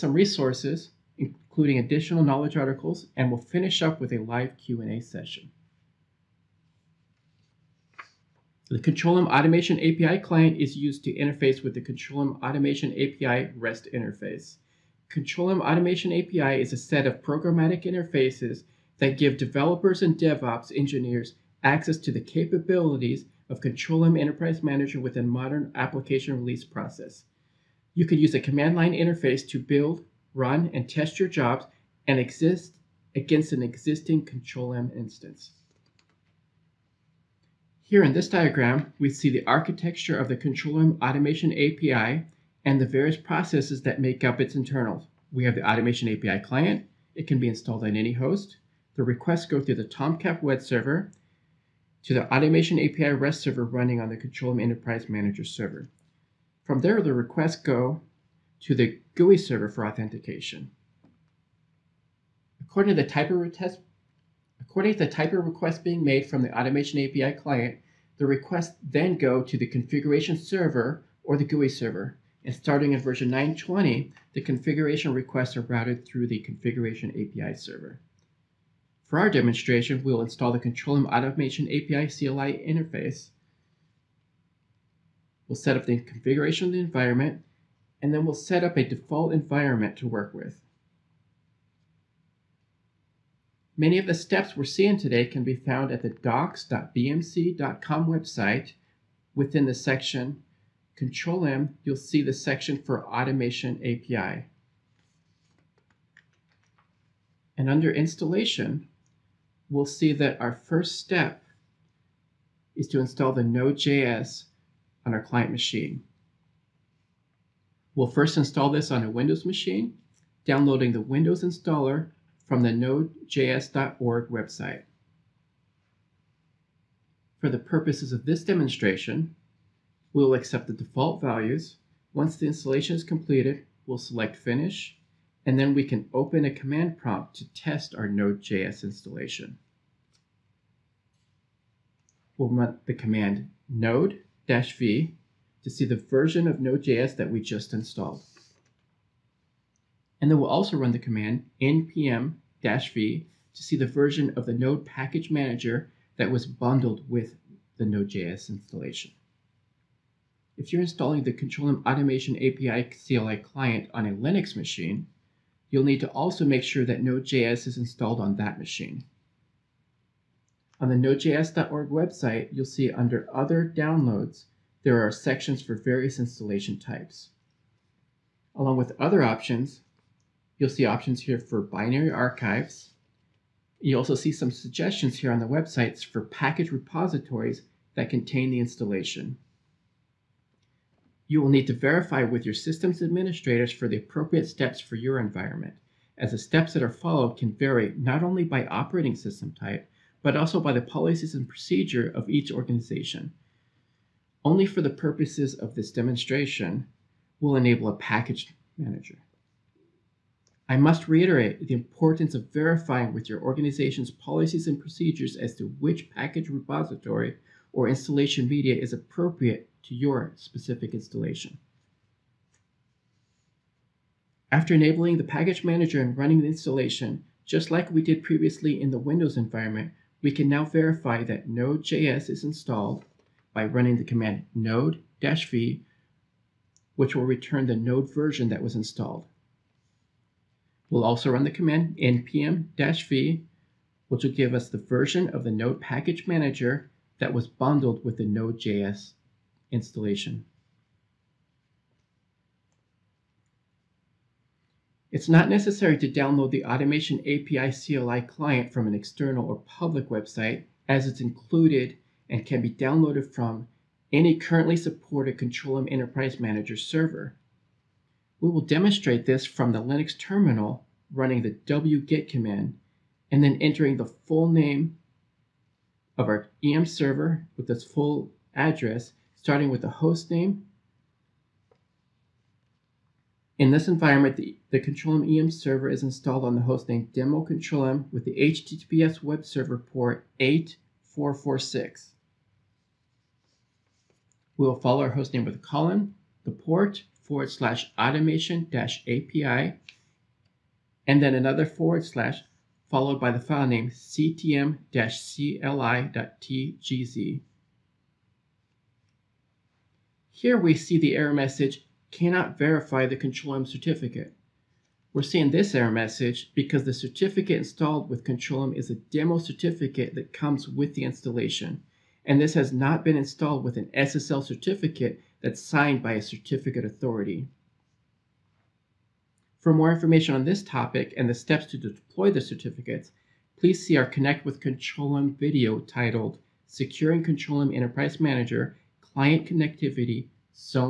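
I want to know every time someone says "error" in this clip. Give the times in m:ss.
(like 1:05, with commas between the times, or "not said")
5:11, 5:15.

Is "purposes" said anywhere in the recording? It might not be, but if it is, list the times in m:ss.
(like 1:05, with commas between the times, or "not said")
2:07, 3:24.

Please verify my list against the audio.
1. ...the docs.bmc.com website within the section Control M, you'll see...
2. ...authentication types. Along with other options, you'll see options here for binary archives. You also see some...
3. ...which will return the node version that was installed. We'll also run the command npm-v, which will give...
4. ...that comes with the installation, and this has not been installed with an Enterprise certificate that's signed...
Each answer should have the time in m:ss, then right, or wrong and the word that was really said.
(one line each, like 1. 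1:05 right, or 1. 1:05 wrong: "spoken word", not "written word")
1. 1:36 right
2. 2:56 wrong: "installation", not "authentication"
3. 3:56 right
4. 5:20 wrong: "SSL", not "Enterprise".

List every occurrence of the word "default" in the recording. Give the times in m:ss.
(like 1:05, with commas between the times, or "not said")
1:28, 2:10.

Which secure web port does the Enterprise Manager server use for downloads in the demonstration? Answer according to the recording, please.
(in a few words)
8446.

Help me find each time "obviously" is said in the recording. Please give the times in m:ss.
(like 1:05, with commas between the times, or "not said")
not said.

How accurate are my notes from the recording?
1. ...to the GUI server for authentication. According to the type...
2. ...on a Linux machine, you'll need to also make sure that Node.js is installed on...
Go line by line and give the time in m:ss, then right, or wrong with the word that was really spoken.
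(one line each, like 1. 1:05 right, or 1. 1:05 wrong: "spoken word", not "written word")
1. 0:58 right
2. 2:43 right.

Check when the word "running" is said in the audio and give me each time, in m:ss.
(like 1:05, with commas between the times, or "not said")
0:53, 3:46, 3:53, 4:31.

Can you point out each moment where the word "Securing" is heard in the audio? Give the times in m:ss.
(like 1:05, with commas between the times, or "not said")
5:36.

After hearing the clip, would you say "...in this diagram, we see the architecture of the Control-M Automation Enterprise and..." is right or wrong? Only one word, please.
wrong.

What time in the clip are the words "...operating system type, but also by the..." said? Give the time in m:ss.
3:18.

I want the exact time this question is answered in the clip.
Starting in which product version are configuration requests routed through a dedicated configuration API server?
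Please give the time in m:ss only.
1:13.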